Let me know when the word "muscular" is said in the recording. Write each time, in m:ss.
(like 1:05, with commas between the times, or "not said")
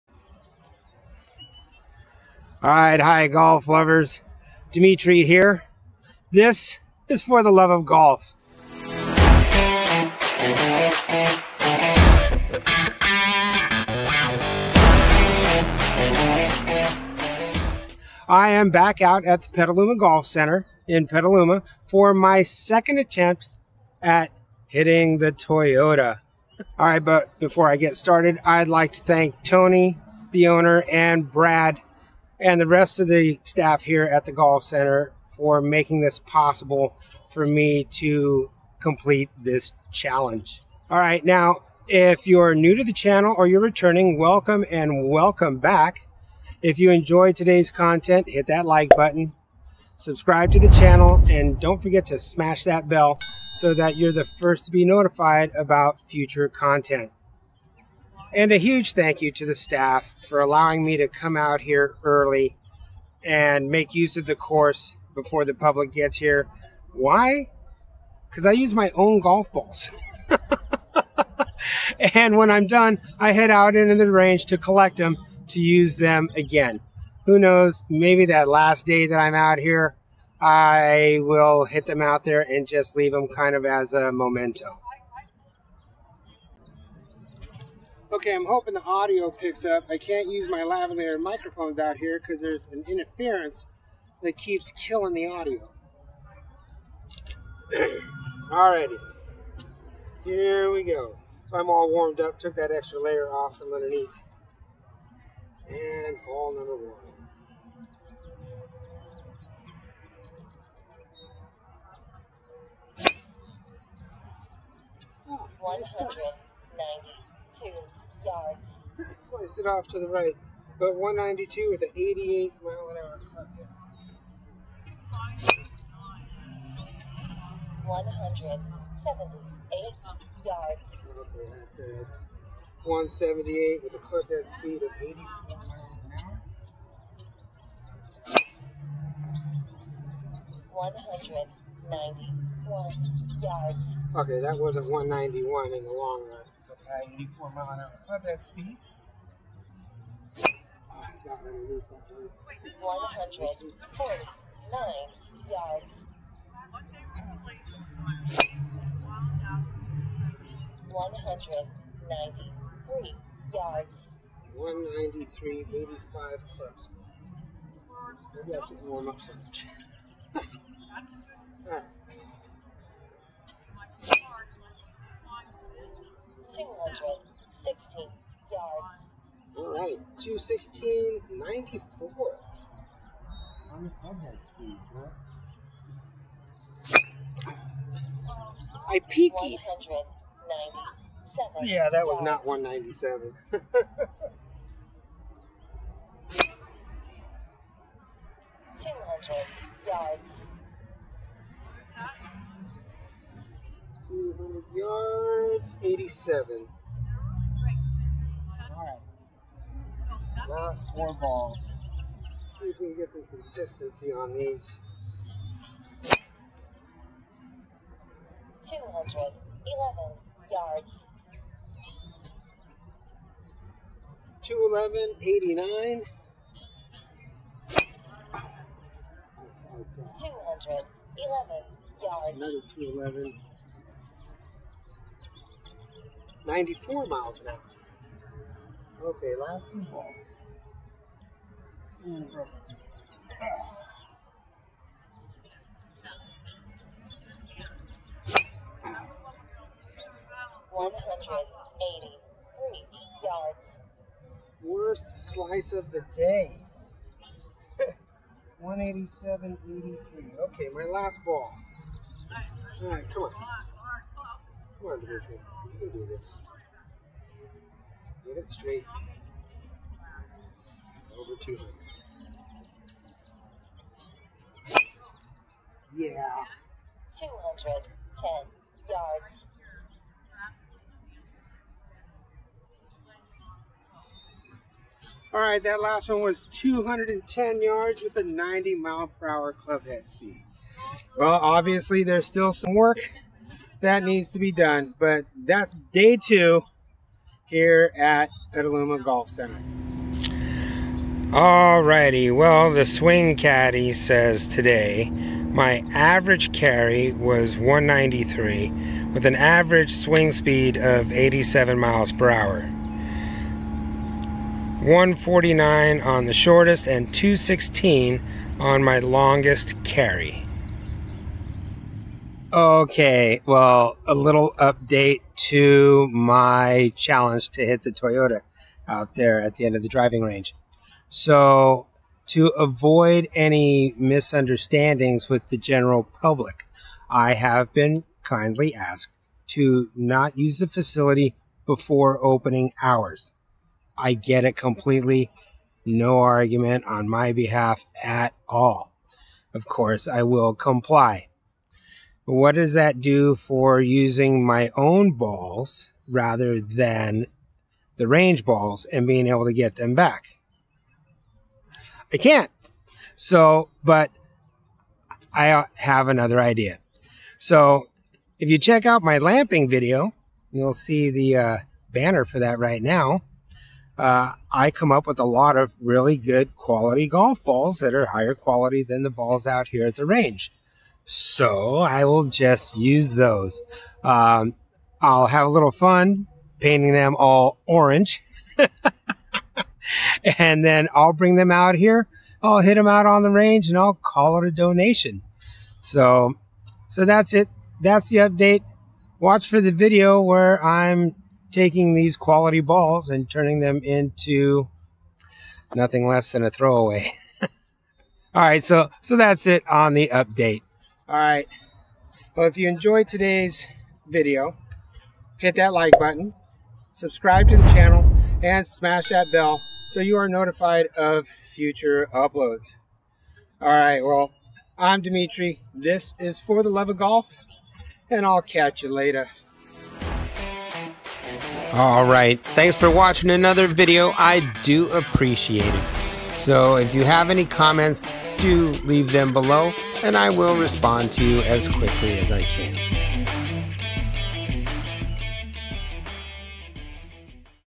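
not said.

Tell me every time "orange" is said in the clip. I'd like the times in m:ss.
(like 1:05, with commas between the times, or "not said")
6:27.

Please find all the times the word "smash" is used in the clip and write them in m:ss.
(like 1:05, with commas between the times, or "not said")
0:52, 6:58.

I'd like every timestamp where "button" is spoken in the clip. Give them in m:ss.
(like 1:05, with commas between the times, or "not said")
0:48, 6:55.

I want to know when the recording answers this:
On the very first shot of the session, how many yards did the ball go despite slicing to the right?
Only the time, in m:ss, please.
1:55.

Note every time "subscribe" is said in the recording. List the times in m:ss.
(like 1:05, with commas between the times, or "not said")
0:49, 6:56.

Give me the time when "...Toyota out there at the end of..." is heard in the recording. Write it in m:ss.
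5:27.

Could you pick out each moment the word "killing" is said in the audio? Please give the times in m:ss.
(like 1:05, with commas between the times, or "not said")
1:34.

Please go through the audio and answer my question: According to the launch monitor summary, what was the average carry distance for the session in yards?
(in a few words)
193.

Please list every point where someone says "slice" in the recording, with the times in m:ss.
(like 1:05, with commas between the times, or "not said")
1:59, 4:15.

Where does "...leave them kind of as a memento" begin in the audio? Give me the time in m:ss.
1:22.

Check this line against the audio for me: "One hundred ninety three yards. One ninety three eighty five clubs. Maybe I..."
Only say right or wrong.
right.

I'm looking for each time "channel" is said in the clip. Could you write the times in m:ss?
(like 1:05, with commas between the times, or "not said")
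0:42, 0:50, 6:57.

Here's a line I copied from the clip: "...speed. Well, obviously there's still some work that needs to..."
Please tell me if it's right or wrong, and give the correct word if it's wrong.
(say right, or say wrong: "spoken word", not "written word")
right.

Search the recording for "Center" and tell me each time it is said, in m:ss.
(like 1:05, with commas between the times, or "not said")
0:20, 0:34, 4:59.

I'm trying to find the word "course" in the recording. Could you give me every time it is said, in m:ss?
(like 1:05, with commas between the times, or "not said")
1:04, 5:49.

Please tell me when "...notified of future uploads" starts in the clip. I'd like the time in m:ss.
7:00.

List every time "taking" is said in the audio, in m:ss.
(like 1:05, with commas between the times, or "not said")
6:41.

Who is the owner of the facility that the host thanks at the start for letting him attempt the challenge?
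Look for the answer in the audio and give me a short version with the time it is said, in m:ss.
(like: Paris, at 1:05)
Tony, at 0:29.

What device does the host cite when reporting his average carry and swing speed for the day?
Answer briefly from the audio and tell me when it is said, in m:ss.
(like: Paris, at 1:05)
Swing Caddie, at 5:02.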